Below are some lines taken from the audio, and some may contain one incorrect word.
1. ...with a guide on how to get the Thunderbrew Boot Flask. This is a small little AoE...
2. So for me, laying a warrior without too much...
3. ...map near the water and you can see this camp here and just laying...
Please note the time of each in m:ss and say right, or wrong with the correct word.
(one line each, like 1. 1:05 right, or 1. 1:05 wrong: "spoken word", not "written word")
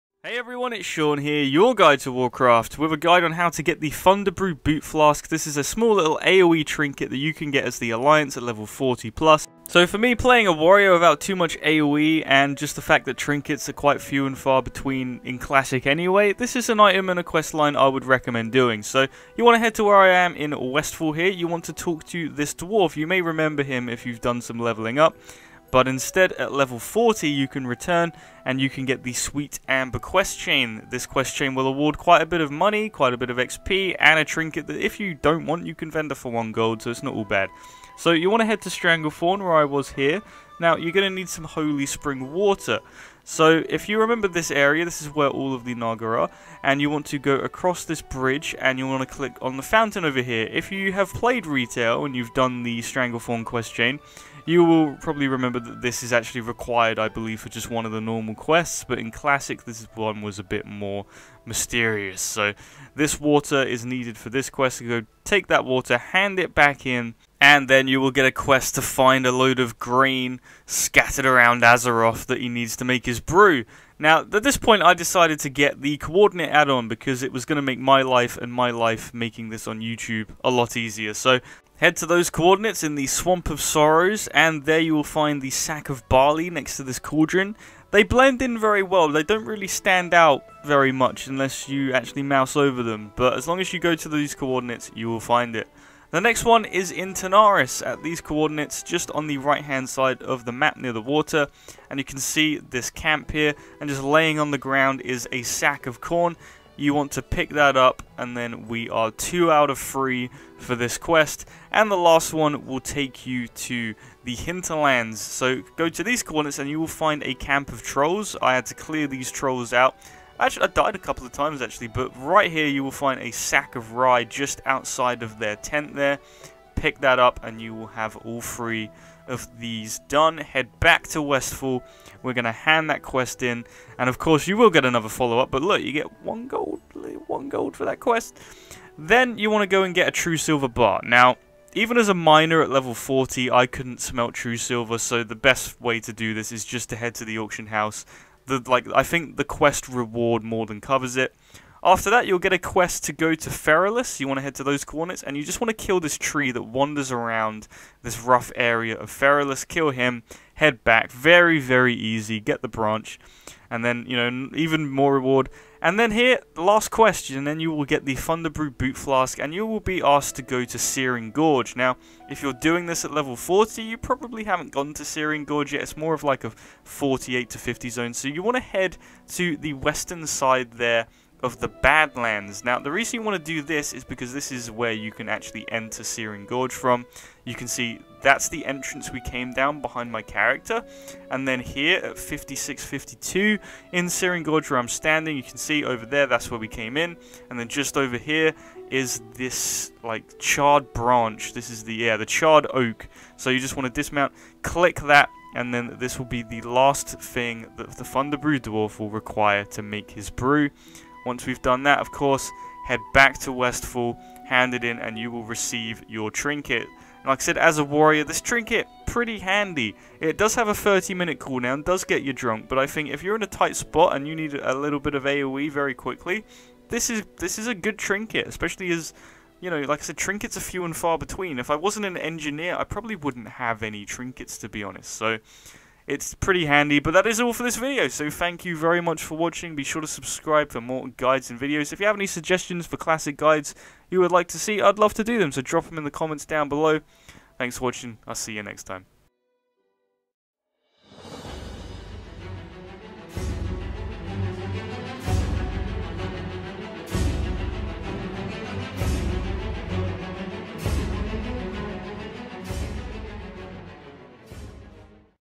1. 0:02 right
2. 0:09 wrong: "playing", not "laying"
3. 1:40 right.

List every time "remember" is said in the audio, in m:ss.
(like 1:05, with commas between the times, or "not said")
0:23, 0:43, 0:55.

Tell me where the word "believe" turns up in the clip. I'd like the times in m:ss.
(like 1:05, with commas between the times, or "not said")
0:57.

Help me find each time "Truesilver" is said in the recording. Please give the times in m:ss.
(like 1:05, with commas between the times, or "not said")
2:20, 2:24.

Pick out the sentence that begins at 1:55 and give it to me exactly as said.
So go to these coordinates and you will find a camp of trolls.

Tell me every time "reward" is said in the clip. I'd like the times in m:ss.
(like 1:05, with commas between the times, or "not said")
2:29, 2:45.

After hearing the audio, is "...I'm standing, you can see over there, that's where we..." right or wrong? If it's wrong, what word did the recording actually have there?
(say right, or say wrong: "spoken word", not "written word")
right.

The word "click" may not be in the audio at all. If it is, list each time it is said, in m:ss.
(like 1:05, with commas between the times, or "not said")
0:49, 3:24.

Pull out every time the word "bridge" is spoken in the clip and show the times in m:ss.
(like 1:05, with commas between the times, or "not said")
0:48.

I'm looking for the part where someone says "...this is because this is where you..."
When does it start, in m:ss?
3:03.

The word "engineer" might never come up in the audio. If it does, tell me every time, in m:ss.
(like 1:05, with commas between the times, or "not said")
3:52.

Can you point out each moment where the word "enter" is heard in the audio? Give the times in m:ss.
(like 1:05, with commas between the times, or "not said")
3:05.